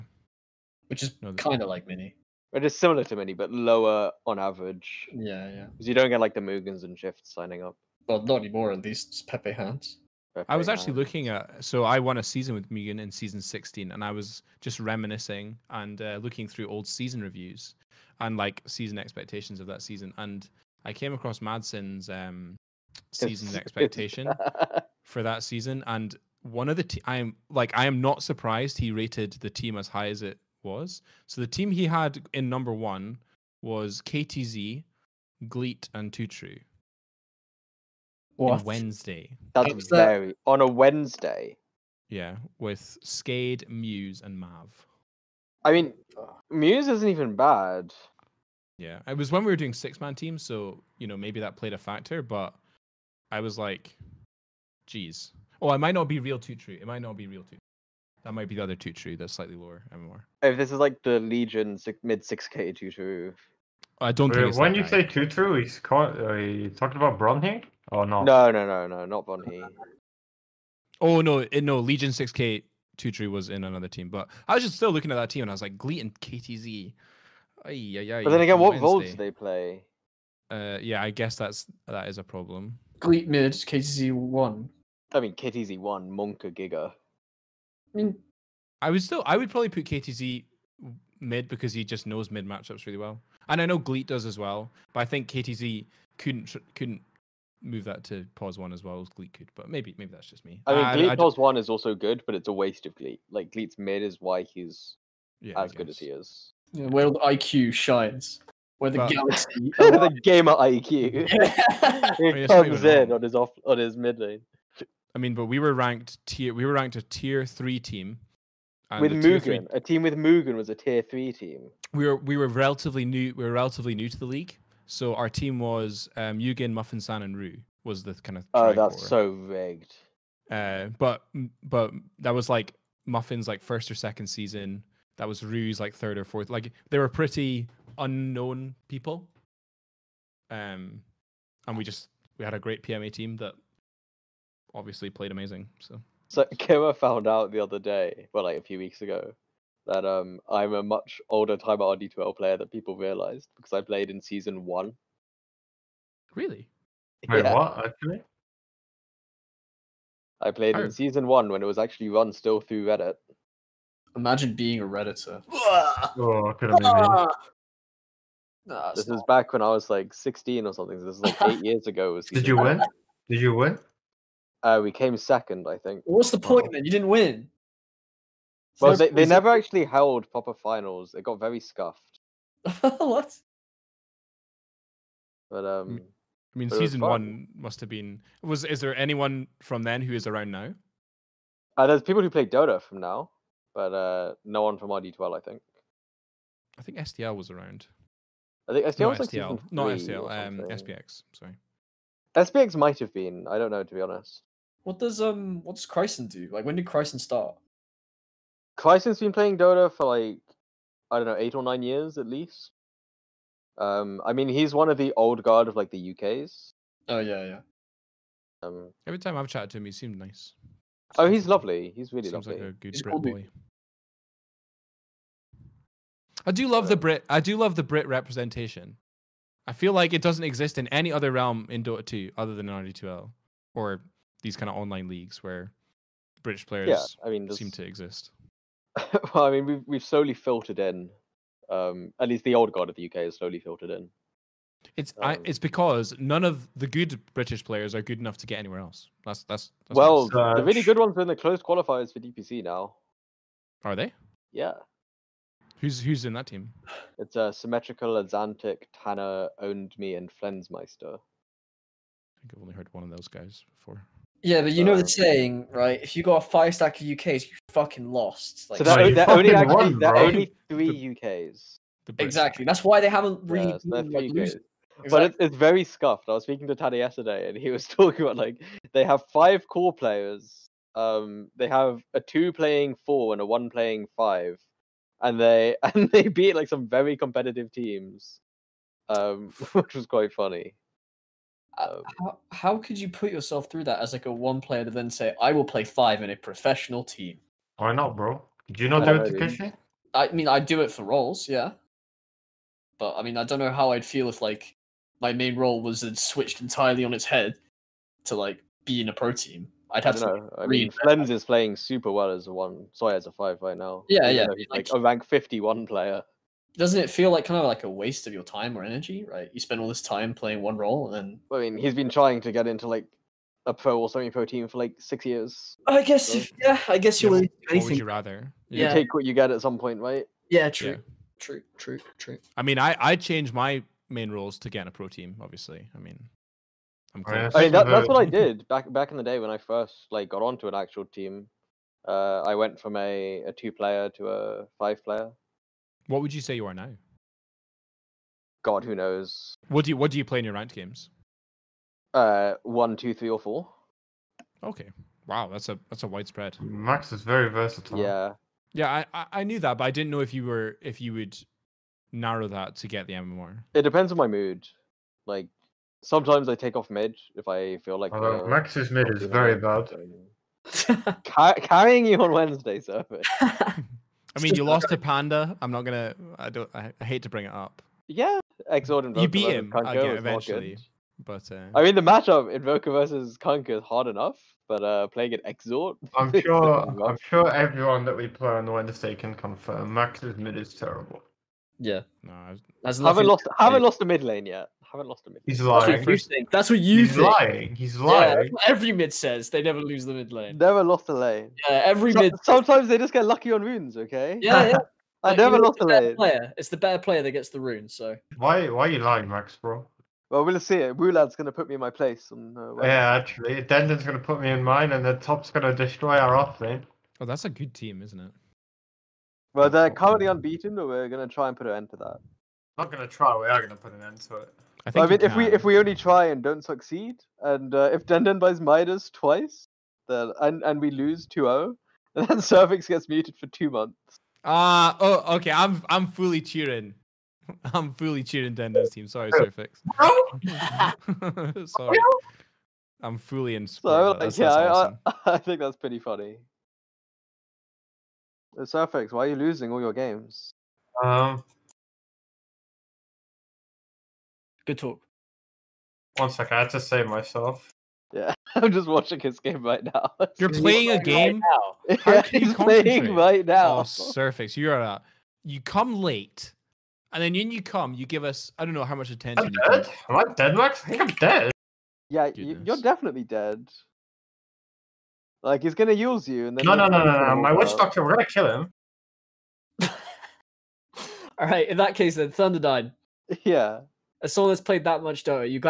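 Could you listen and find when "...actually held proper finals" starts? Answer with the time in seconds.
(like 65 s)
179 s.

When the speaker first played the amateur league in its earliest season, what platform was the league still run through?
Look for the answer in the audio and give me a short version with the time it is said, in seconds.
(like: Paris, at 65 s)
Reddit, at 162 s.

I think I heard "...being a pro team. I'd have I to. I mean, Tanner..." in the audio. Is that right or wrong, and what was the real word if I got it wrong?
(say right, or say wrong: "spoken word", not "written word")
wrong: "Flems", not "Tanner".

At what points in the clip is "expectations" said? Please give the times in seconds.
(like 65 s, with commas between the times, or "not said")
18 s, 23 s.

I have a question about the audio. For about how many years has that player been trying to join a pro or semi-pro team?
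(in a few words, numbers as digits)
6.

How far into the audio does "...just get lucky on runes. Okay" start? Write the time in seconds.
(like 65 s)
402 s.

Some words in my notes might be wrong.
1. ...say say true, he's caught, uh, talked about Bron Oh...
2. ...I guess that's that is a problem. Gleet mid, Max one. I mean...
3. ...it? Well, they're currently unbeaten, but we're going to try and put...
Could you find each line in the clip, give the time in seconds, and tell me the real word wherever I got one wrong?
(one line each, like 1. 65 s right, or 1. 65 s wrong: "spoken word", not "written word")
1. 64 s right
2. 81 s wrong: "KTZ", not "Max"
3. 418 s right.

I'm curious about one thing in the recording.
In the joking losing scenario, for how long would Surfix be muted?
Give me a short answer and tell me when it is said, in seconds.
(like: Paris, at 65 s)
2 months, at 433 s.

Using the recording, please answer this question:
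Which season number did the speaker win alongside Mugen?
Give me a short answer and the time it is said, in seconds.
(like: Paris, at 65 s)
16, at 13 s.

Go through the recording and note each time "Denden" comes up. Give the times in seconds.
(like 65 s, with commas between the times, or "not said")
413 s, 428 s, 438 s.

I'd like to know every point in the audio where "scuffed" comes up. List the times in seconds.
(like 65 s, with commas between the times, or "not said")
181 s, 275 s.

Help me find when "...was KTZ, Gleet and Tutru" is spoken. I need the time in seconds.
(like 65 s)
33 s.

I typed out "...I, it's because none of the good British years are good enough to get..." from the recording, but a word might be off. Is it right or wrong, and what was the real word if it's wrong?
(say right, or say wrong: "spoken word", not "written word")
wrong: "players", not "years".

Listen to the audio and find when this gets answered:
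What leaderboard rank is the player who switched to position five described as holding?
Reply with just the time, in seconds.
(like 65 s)
315 s.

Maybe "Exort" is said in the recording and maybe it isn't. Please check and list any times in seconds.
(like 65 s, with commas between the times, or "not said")
378 s, 385 s.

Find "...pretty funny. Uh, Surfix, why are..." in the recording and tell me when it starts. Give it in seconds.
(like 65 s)
445 s.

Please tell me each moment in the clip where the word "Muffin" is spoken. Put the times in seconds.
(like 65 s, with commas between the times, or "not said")
126 s, 133 s.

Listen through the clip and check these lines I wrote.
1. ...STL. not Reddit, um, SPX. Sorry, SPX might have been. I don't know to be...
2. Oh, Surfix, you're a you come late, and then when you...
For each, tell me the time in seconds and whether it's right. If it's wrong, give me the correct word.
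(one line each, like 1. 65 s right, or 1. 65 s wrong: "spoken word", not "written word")
1. 199 s wrong: "STL", not "Reddit"
2. 463 s right.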